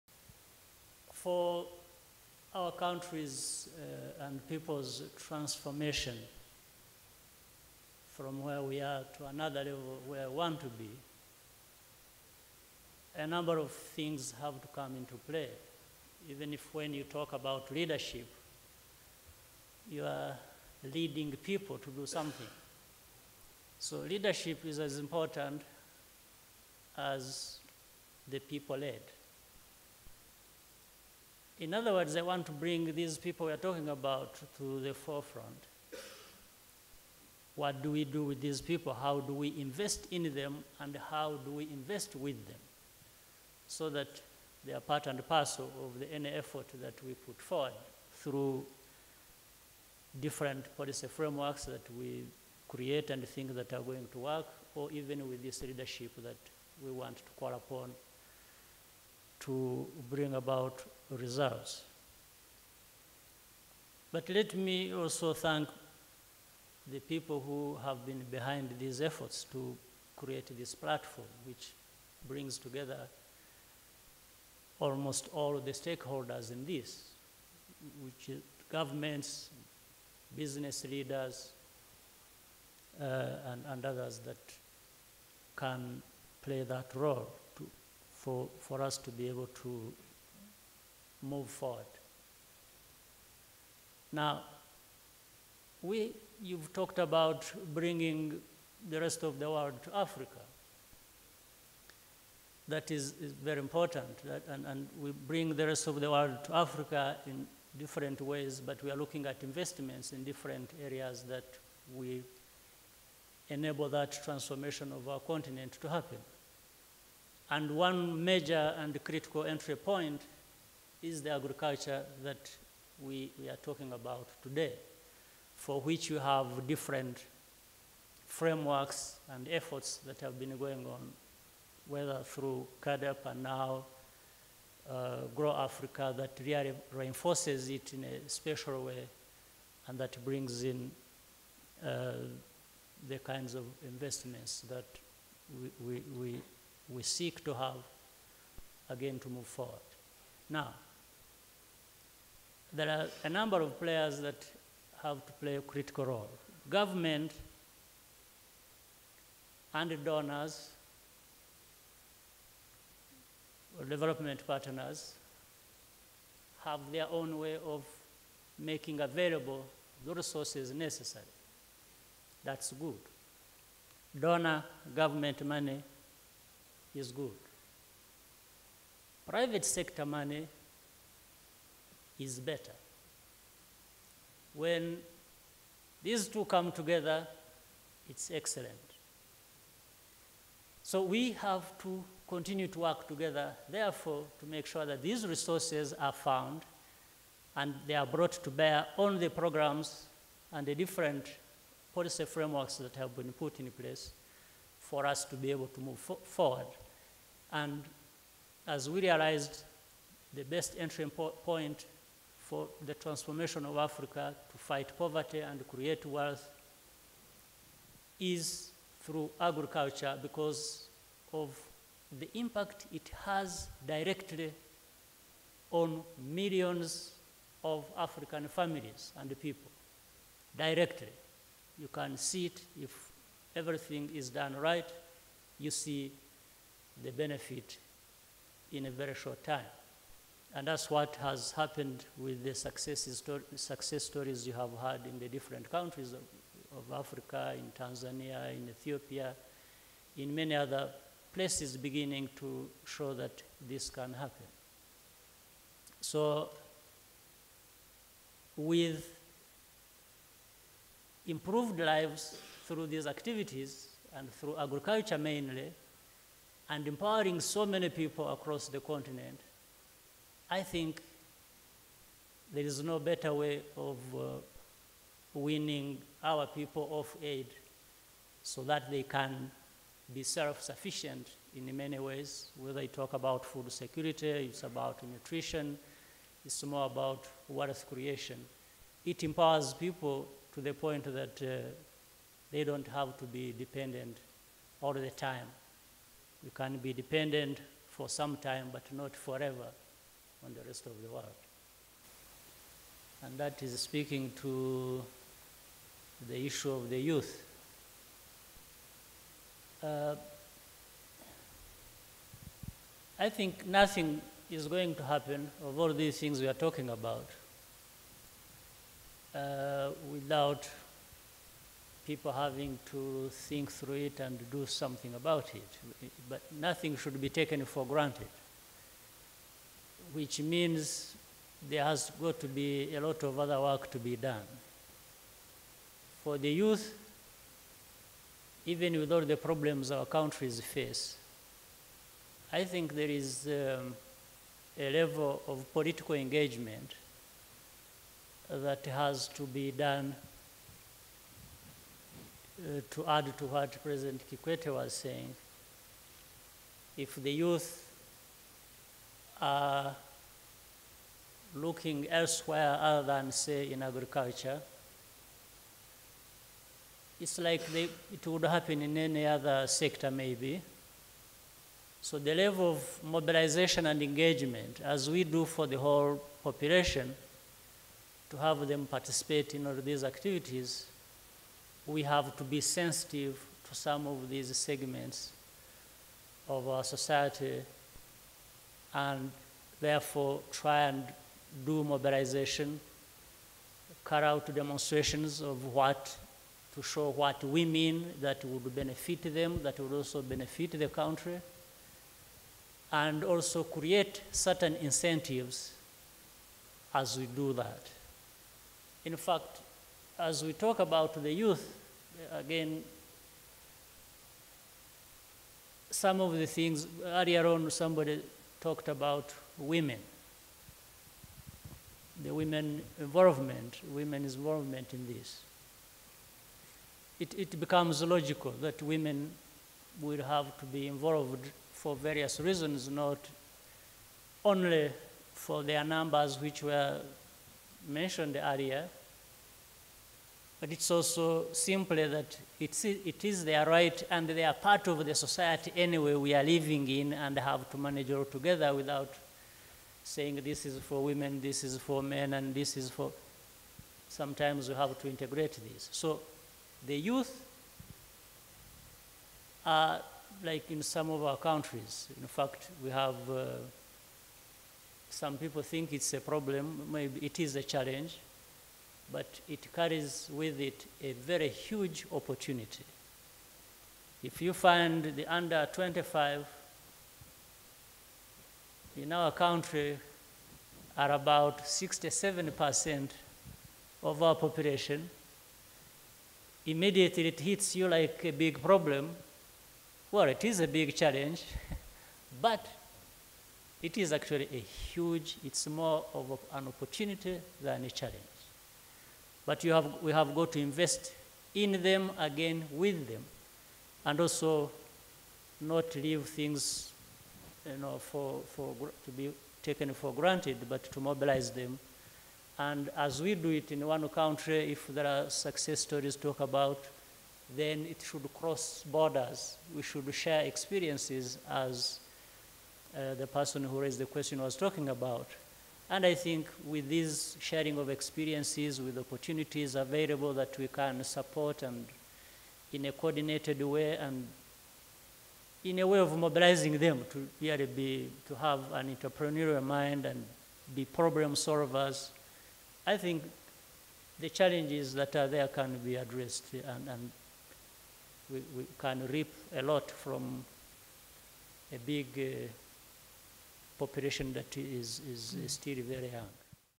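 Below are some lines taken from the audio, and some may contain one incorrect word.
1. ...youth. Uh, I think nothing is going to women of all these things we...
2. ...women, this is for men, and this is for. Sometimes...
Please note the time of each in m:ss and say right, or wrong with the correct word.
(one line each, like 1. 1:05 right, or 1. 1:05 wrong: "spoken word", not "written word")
1. 5:06 wrong: "happen", not "women"
2. 7:31 right.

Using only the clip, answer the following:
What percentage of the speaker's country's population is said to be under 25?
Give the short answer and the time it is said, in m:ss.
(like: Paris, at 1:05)
67%, at 8:01.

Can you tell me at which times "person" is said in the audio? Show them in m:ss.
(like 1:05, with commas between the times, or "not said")
8:43.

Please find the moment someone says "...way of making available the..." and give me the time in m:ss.
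2:47.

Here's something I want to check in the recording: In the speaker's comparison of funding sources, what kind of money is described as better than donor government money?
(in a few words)
Private sector money.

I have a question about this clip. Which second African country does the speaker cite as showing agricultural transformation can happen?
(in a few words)
Ethiopia.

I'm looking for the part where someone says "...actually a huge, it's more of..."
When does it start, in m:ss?
8:14.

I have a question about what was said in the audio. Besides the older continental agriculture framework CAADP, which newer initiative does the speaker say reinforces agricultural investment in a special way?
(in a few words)
Grow Africa.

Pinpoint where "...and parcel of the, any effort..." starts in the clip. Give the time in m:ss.
0:45.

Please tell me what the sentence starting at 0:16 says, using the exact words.
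Even if when you talk about leadership, you are leading people to do something.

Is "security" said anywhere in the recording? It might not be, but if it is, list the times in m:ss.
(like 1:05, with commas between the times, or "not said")
4:43.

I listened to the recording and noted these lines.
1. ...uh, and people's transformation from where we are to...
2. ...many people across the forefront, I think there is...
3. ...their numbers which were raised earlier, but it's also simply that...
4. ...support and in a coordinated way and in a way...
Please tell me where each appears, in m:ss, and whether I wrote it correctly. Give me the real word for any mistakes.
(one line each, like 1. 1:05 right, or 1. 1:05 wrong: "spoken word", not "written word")
1. 0:03 right
2. 4:27 wrong: "continent", not "forefront"
3. 7:15 wrong: "mentioned", not "raised"
4. 8:51 right.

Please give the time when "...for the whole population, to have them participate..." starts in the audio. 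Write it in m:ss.
6:15.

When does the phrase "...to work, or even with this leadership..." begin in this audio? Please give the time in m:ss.
0:54.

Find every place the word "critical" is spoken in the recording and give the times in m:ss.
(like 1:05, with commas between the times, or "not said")
1:59, 2:35.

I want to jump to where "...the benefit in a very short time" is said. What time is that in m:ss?
3:57.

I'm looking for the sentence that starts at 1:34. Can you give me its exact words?
Now, we, you've talked about bringing the rest of the world to Africa.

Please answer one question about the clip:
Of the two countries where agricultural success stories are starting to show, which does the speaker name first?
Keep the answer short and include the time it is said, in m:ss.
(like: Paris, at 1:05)
Tanzania, at 4:07.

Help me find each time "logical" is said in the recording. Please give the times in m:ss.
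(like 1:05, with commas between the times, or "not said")
7:08.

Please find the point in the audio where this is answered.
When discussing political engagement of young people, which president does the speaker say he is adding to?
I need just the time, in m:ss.
5:53.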